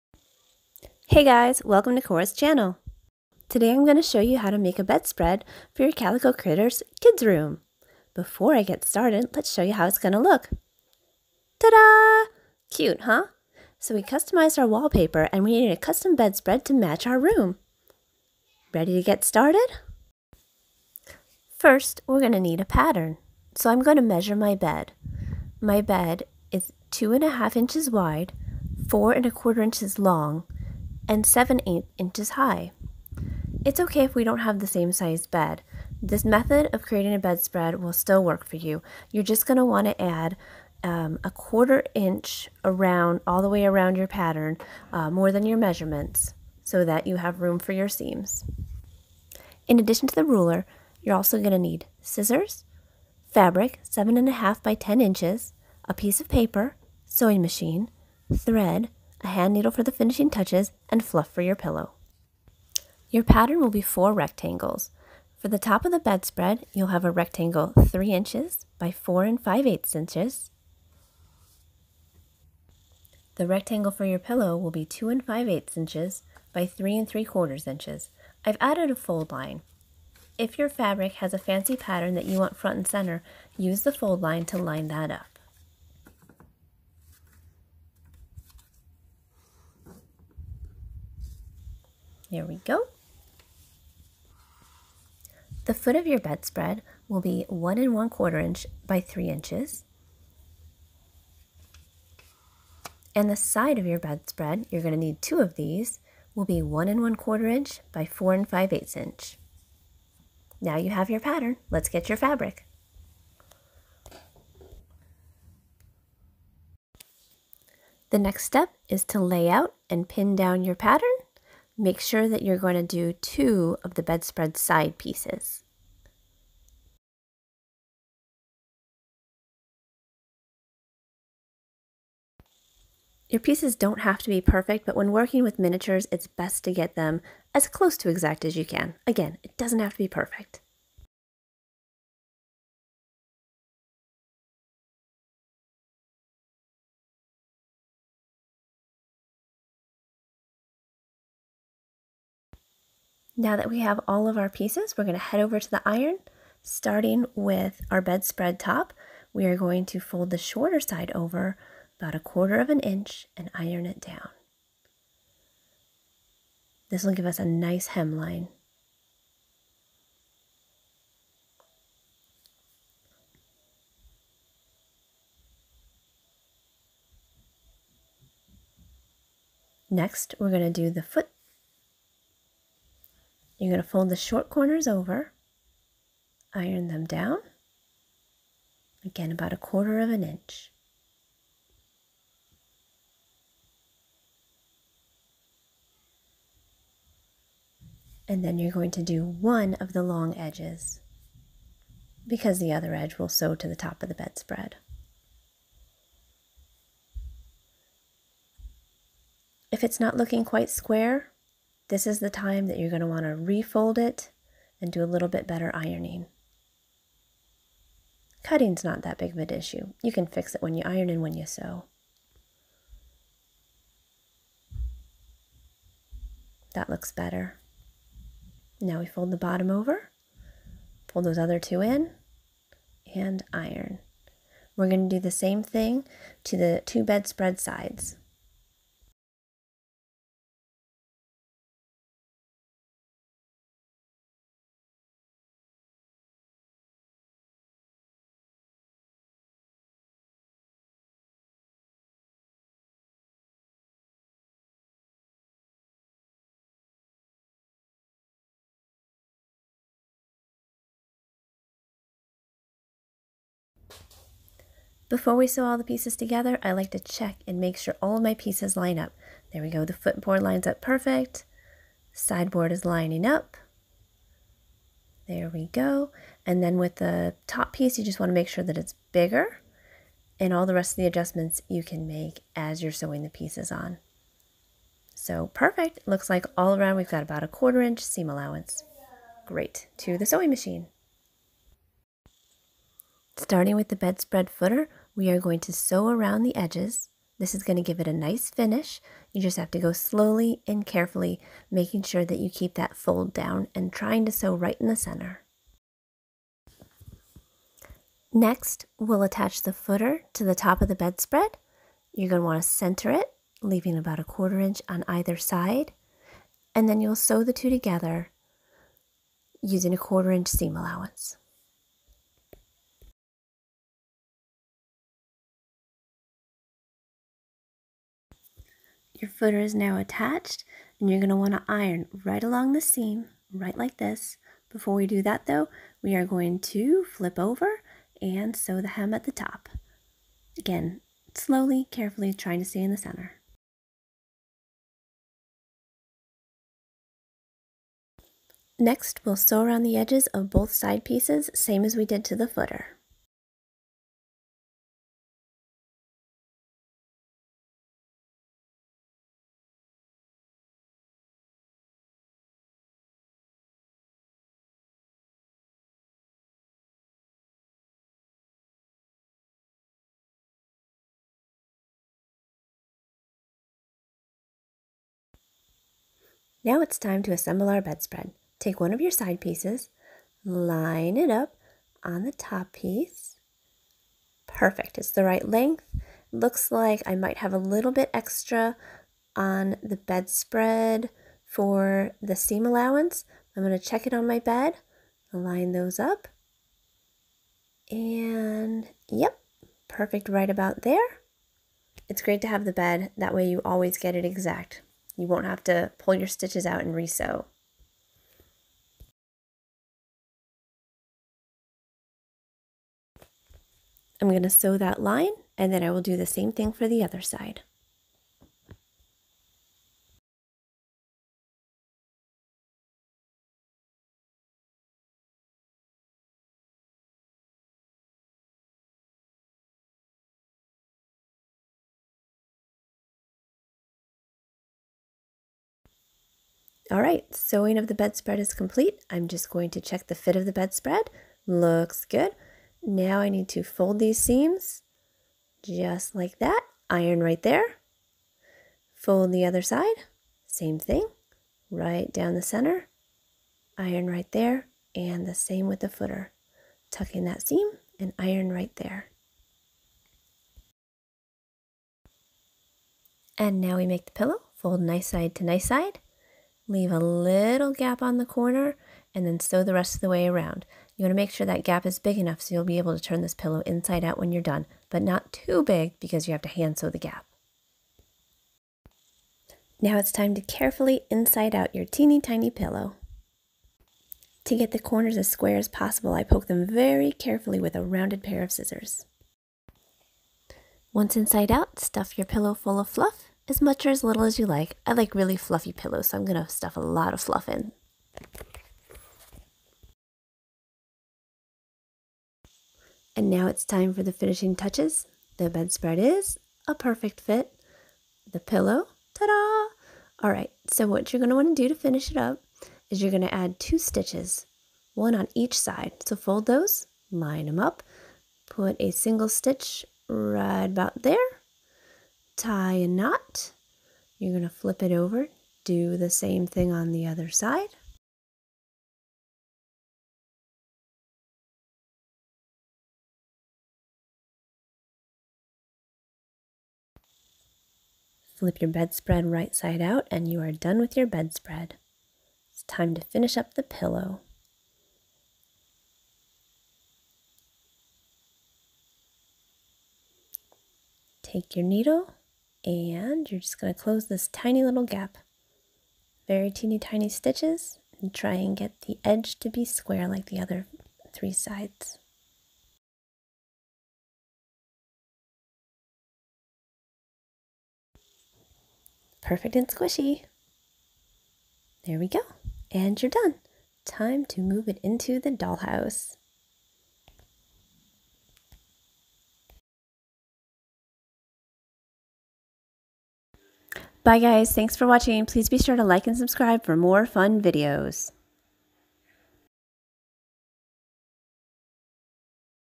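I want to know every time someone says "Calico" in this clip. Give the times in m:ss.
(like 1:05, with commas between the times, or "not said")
0:05.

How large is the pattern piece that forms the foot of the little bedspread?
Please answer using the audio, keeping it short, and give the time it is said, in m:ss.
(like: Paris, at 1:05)
1 1/4 by 3 inches, at 1:37.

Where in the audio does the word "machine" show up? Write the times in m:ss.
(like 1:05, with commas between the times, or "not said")
0:57, 4:50.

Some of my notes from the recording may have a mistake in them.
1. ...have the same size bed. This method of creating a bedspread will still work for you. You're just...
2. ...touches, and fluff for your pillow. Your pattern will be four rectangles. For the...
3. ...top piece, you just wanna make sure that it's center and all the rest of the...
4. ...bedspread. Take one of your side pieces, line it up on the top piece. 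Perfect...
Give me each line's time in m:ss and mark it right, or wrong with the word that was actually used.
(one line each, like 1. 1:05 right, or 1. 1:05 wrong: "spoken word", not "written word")
1. 0:34 right
2. 1:00 right
3. 4:37 wrong: "bigger", not "center"
4. 6:17 right.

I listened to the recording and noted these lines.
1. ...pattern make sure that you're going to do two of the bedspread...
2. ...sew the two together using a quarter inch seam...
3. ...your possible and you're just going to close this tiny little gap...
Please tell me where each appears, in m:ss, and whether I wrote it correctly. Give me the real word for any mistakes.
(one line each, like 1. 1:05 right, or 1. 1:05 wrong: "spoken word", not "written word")
1. 2:00 right
2. 5:17 right
3. 9:11 wrong: "needle", not "possible".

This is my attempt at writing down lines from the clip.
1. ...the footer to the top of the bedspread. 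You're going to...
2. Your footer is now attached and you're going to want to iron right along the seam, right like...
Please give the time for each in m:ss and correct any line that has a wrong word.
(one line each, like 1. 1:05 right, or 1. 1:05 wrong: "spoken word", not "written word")
1. 5:09 right
2. 5:29 right.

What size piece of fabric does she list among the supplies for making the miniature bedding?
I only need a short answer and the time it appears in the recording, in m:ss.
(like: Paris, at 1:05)
7.5 by 10 inches, at 0:53.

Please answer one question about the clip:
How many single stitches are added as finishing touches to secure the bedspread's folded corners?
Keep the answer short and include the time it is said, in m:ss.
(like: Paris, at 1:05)
2, at 8:33.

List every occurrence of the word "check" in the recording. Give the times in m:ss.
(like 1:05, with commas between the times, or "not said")
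4:26, 6:33, 7:19.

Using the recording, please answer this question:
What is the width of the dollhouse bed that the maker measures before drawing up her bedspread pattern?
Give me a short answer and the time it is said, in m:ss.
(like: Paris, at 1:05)
2 1/2 inches, at 0:26.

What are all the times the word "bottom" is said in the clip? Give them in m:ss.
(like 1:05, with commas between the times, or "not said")
3:49.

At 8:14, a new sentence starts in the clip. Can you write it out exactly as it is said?
I like really fluffy pillows, so I'm going to stuff a lot of fluff in.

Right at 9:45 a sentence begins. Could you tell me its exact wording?
Please be sure to like and subscribe for more fun videos.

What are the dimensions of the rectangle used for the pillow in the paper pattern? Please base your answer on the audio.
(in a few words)
2 5/8 by 3 3/4 inches.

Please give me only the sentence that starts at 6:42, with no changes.
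It's great to have the bed, that way you always get it exact.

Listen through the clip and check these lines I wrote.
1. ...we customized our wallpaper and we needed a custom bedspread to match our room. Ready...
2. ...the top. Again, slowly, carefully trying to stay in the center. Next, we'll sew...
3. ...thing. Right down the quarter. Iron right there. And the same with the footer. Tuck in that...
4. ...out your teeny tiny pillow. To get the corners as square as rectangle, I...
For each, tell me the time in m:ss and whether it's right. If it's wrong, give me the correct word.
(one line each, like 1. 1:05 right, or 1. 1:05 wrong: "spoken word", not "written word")
1. 0:13 right
2. 5:39 right
3. 7:30 wrong: "center", not "quarter"
4. 8:01 wrong: "possible", not "rectangle".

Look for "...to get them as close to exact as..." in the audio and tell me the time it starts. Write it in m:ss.
2:16.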